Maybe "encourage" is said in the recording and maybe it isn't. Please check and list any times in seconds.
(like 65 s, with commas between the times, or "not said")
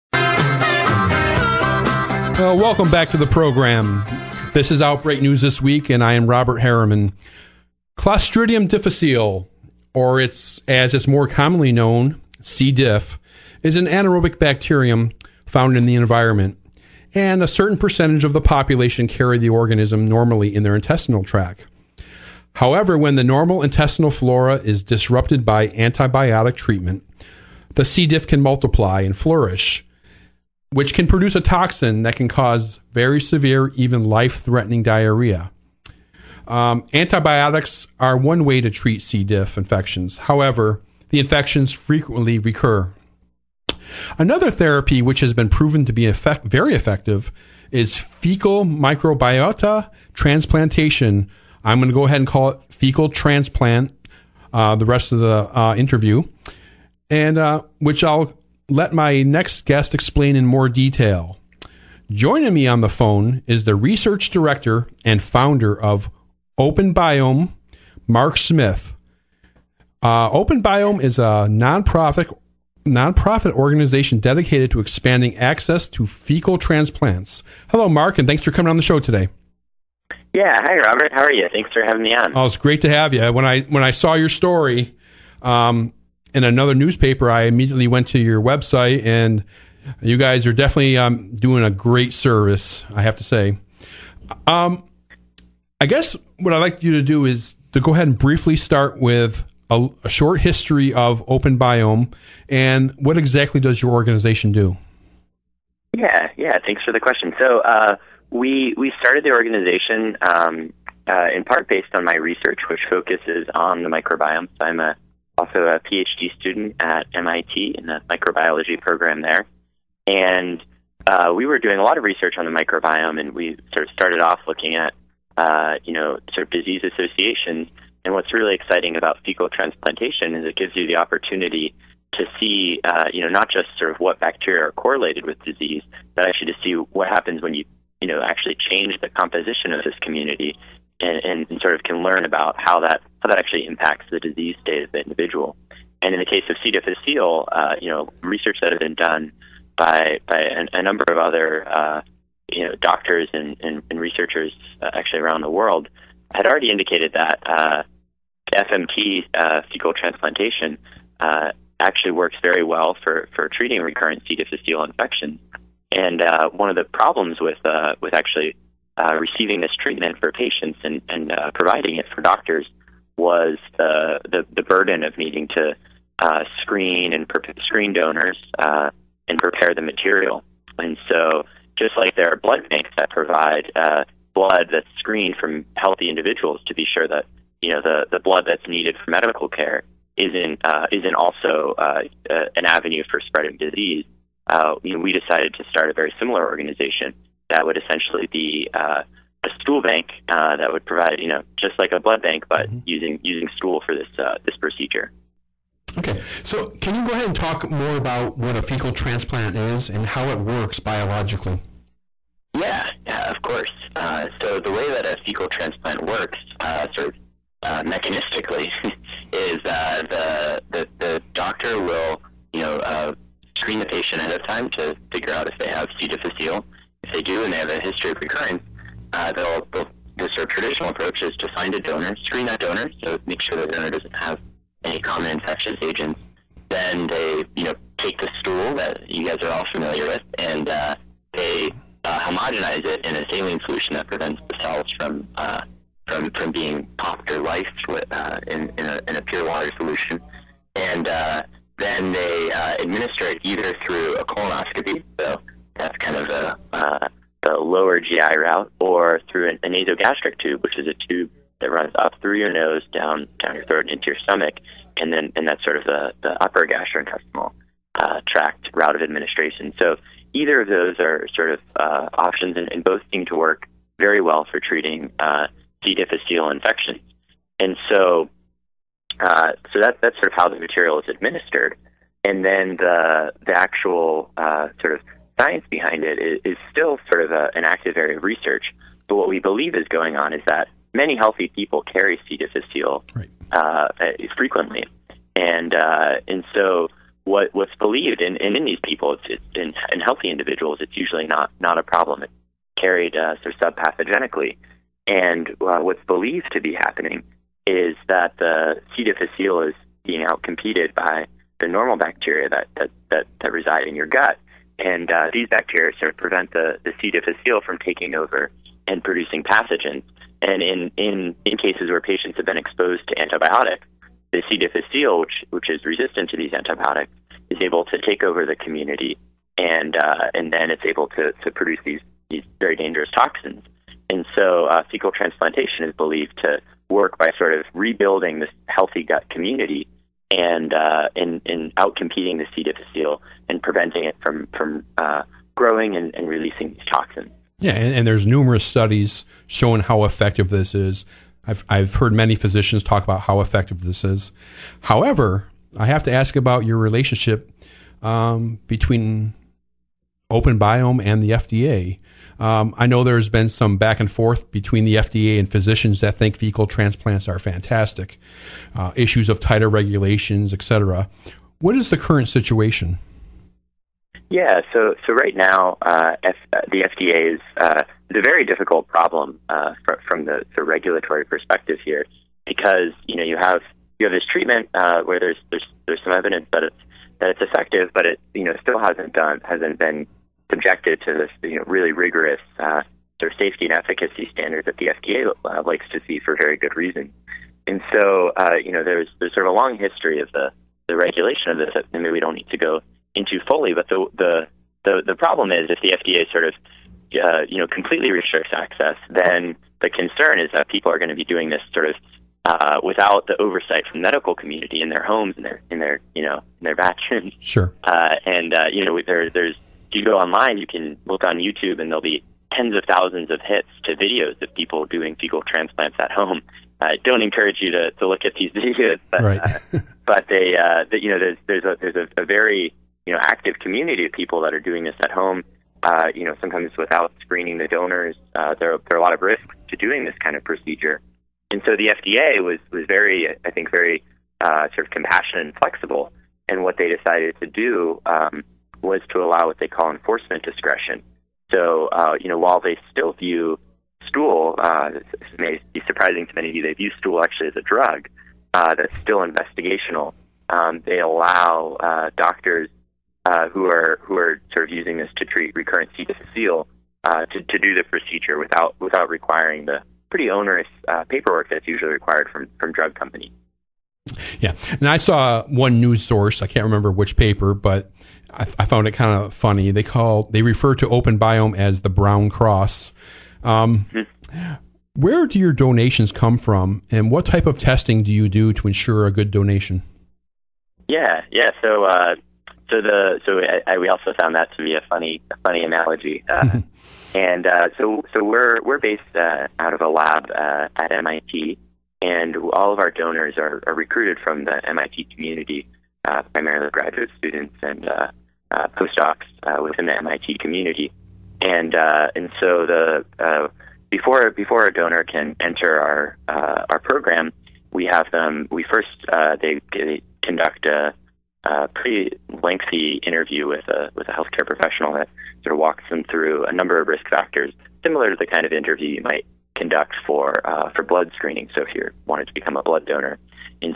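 427 s.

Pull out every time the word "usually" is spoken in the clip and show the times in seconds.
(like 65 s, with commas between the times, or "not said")
300 s, 471 s.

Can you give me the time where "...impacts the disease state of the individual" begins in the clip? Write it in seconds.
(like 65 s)
143 s.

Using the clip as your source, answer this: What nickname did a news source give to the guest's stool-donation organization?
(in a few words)
The brown cross.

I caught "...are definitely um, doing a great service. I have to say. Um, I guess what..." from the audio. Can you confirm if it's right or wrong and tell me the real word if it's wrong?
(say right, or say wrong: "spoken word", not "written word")
right.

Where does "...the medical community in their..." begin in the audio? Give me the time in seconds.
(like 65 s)
413 s.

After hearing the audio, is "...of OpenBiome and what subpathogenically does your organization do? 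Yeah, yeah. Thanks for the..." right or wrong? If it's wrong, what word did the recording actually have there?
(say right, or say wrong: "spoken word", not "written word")
wrong: "exactly", not "subpathogenically".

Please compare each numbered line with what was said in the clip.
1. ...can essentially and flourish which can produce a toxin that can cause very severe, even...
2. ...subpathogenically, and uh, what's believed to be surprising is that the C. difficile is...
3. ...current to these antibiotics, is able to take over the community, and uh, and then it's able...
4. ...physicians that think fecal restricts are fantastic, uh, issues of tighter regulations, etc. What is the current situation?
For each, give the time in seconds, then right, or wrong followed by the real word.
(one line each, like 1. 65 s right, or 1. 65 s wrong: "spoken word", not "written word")
1. 28 s wrong: "multiply", not "essentially"
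2. 303 s wrong: "happening", not "surprising"
3. 325 s wrong: "resistant", not "current"
4. 365 s wrong: "transplants", not "restricts".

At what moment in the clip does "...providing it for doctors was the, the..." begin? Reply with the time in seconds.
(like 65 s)
171 s.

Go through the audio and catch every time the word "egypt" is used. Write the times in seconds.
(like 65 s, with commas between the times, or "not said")
not said.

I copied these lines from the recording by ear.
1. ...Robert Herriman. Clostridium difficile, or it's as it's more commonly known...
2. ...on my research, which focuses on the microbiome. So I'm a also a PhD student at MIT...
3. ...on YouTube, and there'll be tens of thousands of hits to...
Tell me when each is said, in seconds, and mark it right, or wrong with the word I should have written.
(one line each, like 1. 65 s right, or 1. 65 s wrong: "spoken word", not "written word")
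1. 6 s right
2. 111 s right
3. 421 s right.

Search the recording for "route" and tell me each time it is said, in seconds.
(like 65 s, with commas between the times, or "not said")
258 s, 268 s.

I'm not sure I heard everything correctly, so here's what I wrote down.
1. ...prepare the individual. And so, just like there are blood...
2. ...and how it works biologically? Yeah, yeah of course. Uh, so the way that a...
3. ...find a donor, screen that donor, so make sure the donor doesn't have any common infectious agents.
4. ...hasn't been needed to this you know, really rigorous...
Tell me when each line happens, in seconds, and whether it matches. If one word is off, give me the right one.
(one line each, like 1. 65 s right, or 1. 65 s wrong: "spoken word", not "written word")
1. 179 s wrong: "material", not "individual"
2. 209 s right
3. 231 s right
4. 389 s wrong: "subjected", not "needed".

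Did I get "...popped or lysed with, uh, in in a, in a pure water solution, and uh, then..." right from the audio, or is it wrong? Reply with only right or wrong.
right.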